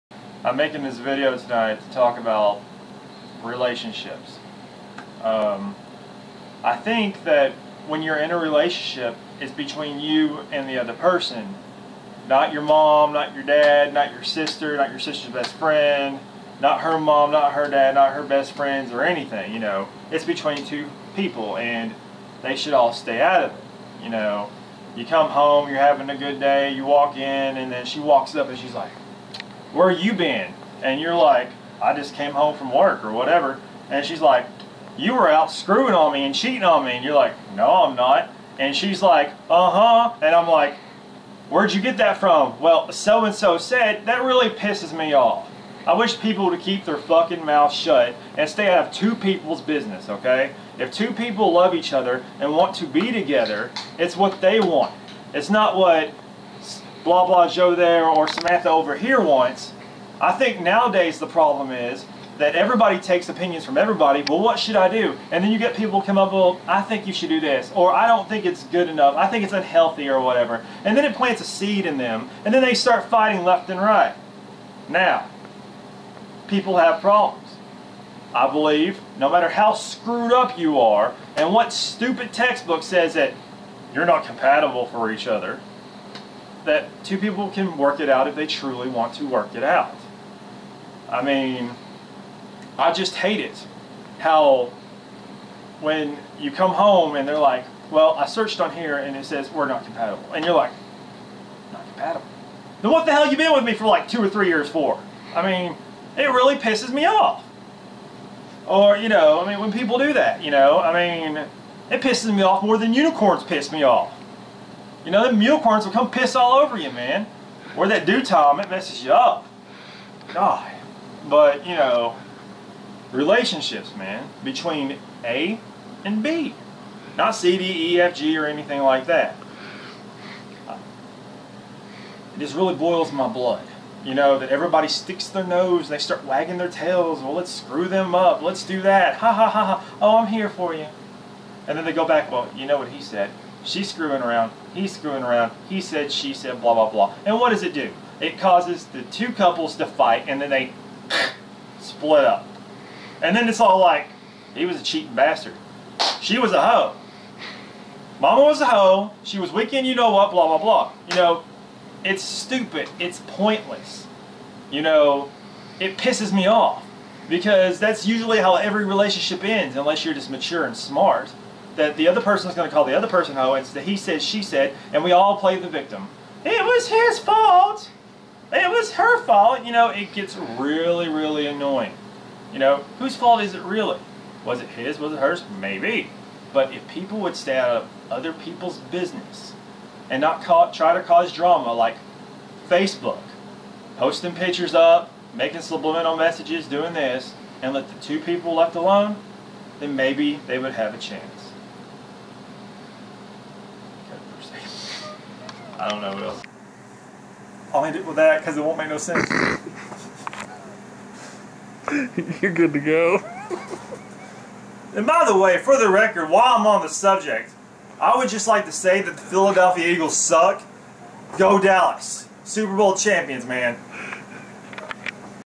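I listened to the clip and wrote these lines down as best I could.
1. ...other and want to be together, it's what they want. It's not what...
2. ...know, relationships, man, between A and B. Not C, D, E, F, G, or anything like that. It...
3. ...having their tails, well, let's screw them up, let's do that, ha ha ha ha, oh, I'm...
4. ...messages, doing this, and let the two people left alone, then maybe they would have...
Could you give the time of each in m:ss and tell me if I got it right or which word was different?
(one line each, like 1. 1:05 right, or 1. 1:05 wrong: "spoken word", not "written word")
1. 0:51 right
2. 2:01 right
3. 2:16 wrong: "wagging", not "having"
4. 3:16 right.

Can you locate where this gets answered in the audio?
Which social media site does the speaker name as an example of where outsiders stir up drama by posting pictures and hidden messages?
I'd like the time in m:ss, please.
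3:12.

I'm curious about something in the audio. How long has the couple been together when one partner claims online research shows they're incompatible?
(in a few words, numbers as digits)
2 or 3 years.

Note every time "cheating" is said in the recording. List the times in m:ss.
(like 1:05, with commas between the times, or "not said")
0:36, 2:34.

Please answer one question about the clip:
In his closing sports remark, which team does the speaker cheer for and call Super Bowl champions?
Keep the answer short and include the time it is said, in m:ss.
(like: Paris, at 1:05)
Dallas, at 3:41.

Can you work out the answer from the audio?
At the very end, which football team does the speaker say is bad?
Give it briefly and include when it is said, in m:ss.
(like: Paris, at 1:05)
Philadelphia Eagles, at 3:39.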